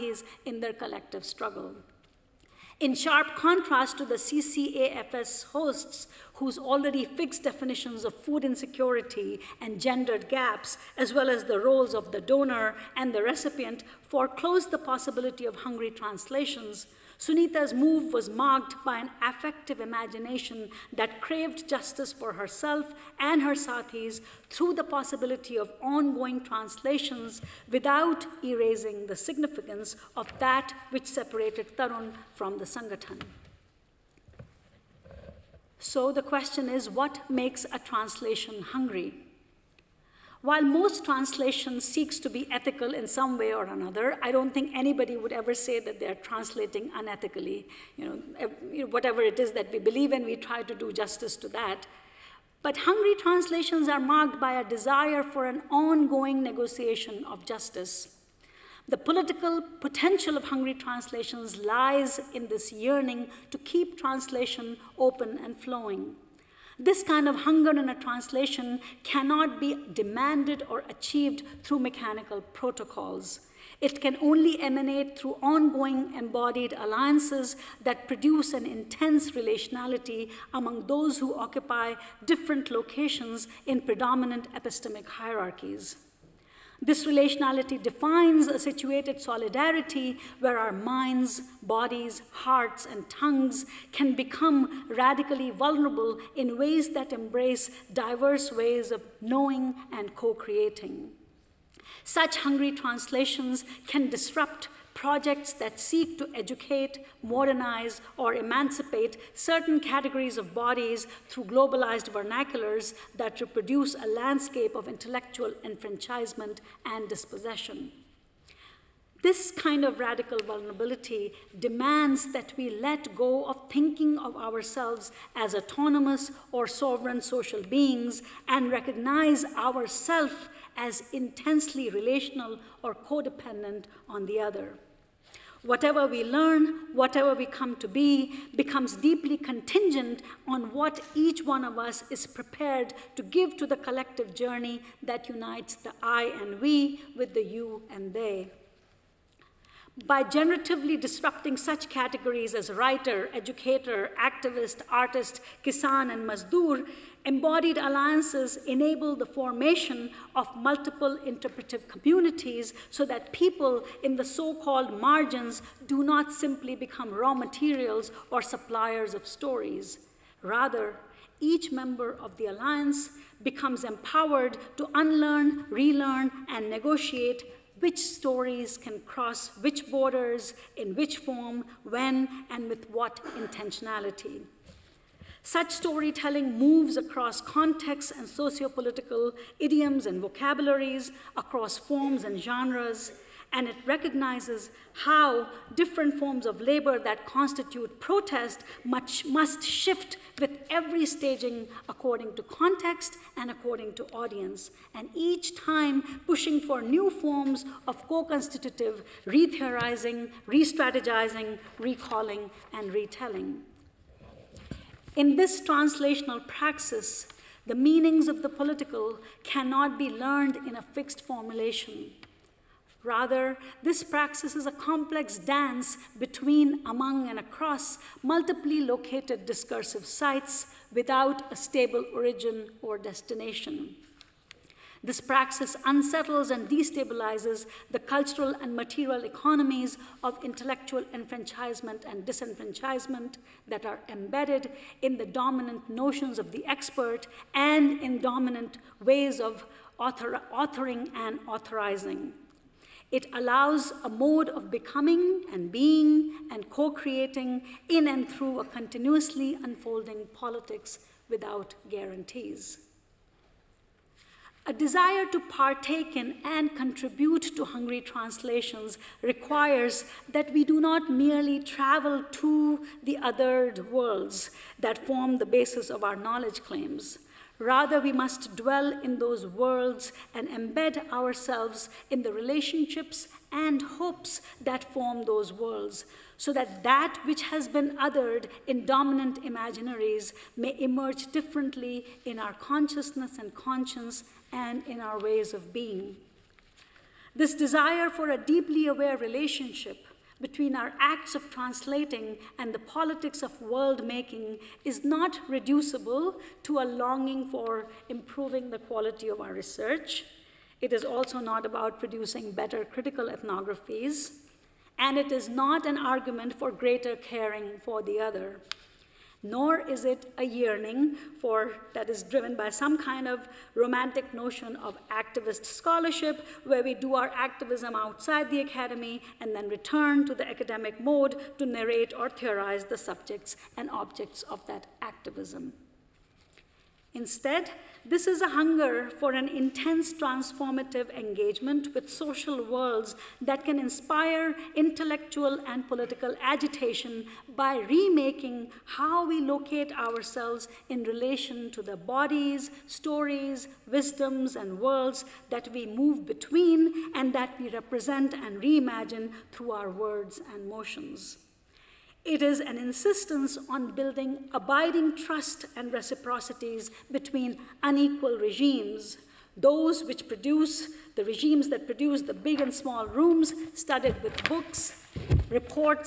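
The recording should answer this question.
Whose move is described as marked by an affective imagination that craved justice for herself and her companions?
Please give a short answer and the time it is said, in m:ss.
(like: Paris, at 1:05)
Sunita, at 0:17.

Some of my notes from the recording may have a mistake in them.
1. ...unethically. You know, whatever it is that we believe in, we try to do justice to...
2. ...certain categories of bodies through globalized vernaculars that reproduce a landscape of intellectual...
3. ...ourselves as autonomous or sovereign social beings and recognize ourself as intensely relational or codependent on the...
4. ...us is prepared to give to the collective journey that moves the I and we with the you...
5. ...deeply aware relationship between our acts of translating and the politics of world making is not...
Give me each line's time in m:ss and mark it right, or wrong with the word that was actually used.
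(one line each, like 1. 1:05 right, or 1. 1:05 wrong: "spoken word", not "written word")
1. 0:46 right
2. 1:49 right
3. 2:04 right
4. 2:21 wrong: "unites", not "moves"
5. 4:58 right.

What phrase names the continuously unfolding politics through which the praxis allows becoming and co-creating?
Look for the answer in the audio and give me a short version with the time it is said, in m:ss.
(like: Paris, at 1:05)
politics without guarantees, at 4:20.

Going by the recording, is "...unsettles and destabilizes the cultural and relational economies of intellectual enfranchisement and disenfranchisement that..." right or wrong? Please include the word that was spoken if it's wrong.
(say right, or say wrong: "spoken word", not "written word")
wrong: "material", not "relational".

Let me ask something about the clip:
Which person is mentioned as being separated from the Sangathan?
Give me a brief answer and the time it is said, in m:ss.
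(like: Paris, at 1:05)
Tarun, at 0:31.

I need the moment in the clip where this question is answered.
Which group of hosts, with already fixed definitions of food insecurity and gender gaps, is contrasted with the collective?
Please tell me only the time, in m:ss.
0:04.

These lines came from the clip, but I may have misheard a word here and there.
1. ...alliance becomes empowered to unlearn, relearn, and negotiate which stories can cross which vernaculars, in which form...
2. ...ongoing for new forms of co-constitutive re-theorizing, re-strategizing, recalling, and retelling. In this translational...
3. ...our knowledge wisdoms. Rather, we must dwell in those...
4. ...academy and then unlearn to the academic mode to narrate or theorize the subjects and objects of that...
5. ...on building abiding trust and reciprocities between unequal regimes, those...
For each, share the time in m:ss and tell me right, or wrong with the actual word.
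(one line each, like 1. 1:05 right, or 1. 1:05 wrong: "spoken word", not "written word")
1. 2:52 wrong: "borders", not "vernaculars"
2. 3:26 wrong: "pushing", not "ongoing"
3. 4:36 wrong: "claims", not "wisdoms"
4. 5:28 wrong: "return", not "unlearn"
5. 6:03 right.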